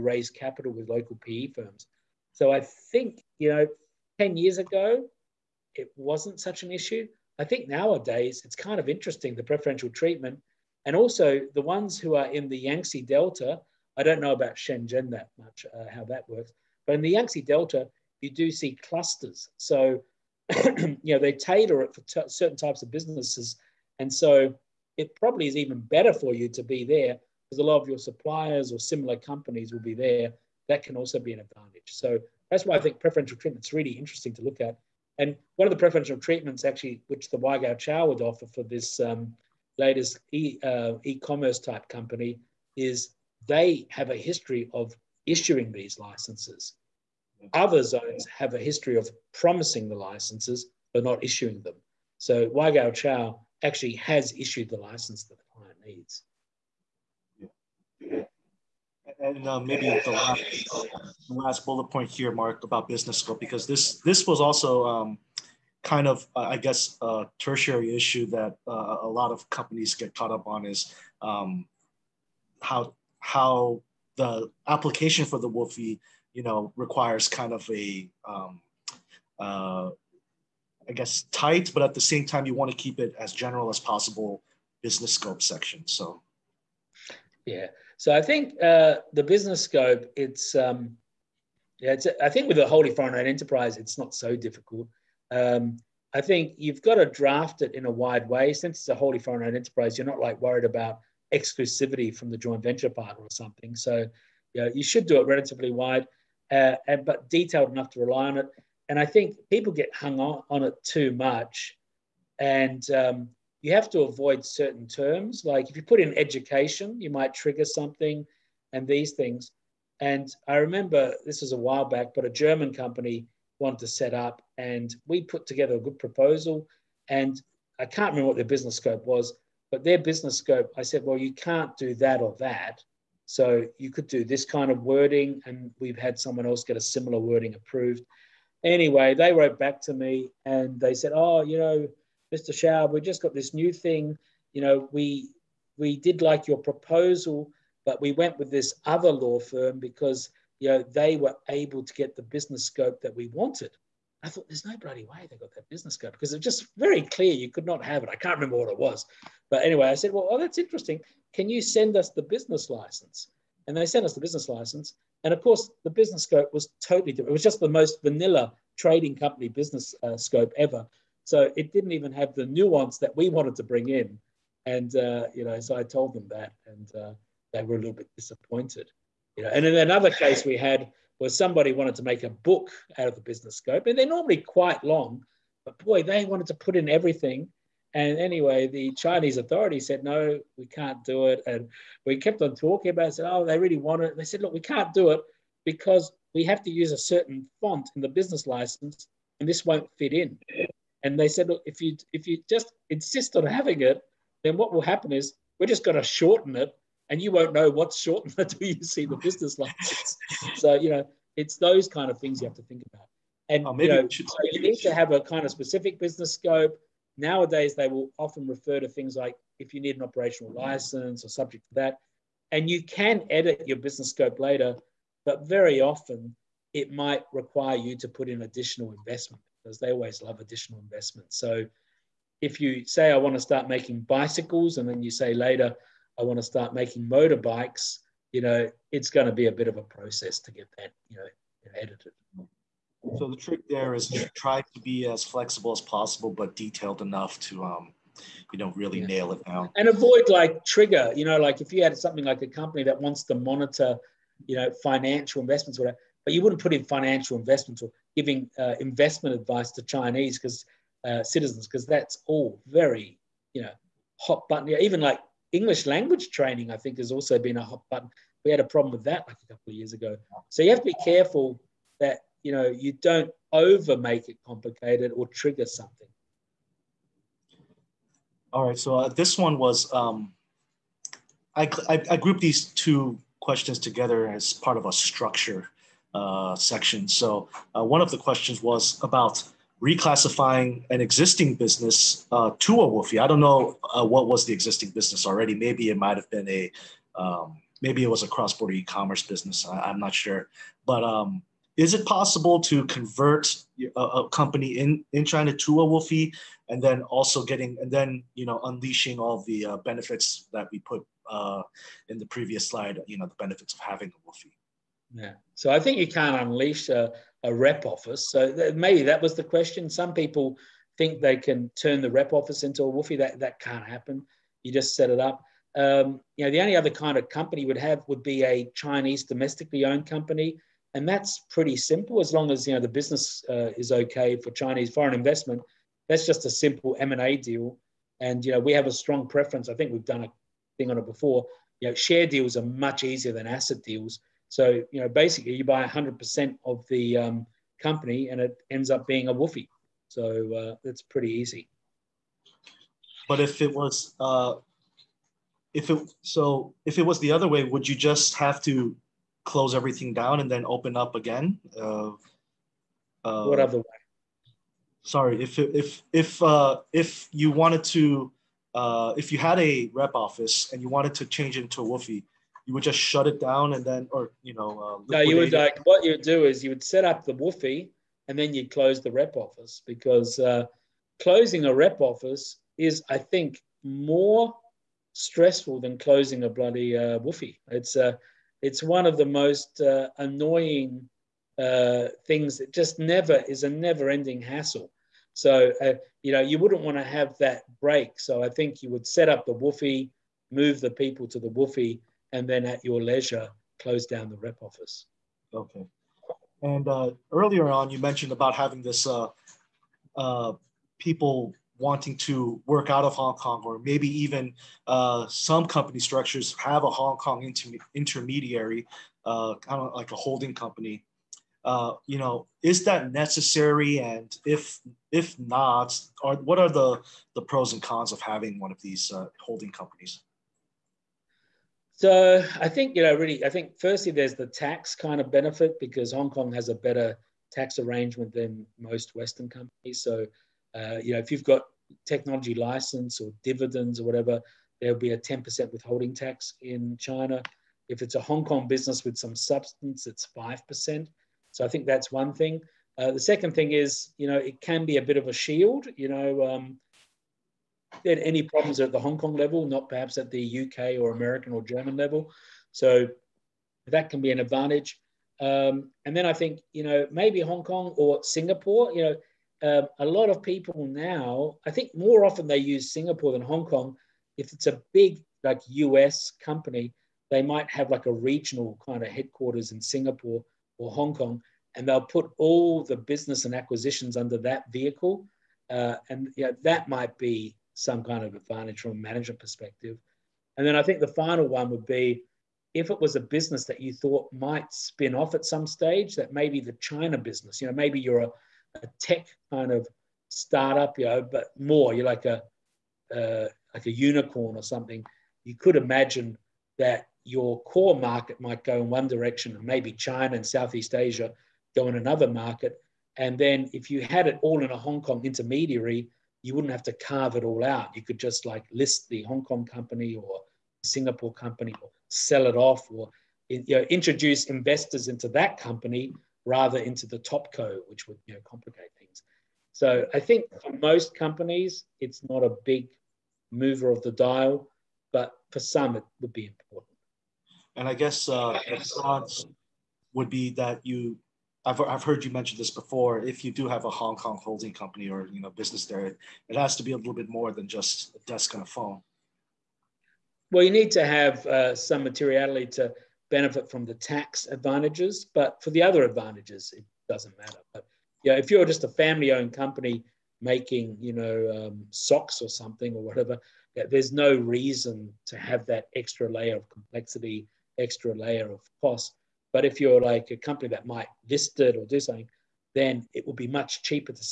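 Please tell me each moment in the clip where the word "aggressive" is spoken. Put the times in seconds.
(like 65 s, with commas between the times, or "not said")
not said.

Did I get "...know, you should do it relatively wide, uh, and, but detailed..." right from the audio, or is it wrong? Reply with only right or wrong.
right.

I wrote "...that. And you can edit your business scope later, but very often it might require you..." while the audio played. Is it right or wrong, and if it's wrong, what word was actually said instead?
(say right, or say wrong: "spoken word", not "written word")
right.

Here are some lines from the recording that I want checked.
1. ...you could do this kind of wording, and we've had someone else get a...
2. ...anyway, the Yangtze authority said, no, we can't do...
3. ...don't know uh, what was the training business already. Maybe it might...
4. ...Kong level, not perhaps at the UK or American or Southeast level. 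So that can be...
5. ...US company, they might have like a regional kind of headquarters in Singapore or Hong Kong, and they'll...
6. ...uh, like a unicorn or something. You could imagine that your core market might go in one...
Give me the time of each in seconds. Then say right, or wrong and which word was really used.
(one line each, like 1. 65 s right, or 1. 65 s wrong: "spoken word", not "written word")
1. 133 s right
2. 188 s wrong: "Chinese", not "Yangtze"
3. 293 s wrong: "existing", not "training"
4. 459 s wrong: "German", not "Southeast"
5. 475 s right
6. 503 s right.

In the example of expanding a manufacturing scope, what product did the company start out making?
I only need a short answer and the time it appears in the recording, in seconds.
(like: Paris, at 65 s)
bicycles, at 234 s.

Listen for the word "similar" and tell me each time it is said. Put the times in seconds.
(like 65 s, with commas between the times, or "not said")
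28 s, 136 s.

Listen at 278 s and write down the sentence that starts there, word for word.
So uh, this one was um, I, I I grouped these two questions together as part of a structure.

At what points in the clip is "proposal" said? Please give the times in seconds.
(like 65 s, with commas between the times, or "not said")
125 s, 146 s.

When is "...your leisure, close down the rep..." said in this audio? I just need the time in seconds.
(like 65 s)
402 s.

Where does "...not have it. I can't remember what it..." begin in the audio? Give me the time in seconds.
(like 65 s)
157 s.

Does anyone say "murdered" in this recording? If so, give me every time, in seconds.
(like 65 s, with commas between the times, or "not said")
not said.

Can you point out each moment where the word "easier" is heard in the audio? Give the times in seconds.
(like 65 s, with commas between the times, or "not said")
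343 s.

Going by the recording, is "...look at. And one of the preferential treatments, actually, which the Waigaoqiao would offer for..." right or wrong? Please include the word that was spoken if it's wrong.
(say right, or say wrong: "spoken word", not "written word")
right.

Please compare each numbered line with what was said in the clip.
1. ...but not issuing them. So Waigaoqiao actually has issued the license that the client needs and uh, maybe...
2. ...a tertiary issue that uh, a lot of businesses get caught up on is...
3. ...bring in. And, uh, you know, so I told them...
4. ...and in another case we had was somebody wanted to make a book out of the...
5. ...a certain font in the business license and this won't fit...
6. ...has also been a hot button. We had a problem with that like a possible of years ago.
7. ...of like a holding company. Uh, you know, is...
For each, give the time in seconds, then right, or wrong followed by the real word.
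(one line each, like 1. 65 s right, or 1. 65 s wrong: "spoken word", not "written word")
1. 50 s right
2. 67 s wrong: "companies", not "businesses"
3. 173 s right
4. 179 s right
5. 196 s right
6. 266 s wrong: "couple", not "possible"
7. 419 s right.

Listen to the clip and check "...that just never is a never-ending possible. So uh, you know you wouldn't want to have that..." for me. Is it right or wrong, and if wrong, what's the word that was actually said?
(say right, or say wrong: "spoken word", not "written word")
wrong: "hassle", not "possible".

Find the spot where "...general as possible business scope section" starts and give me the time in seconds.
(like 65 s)
83 s.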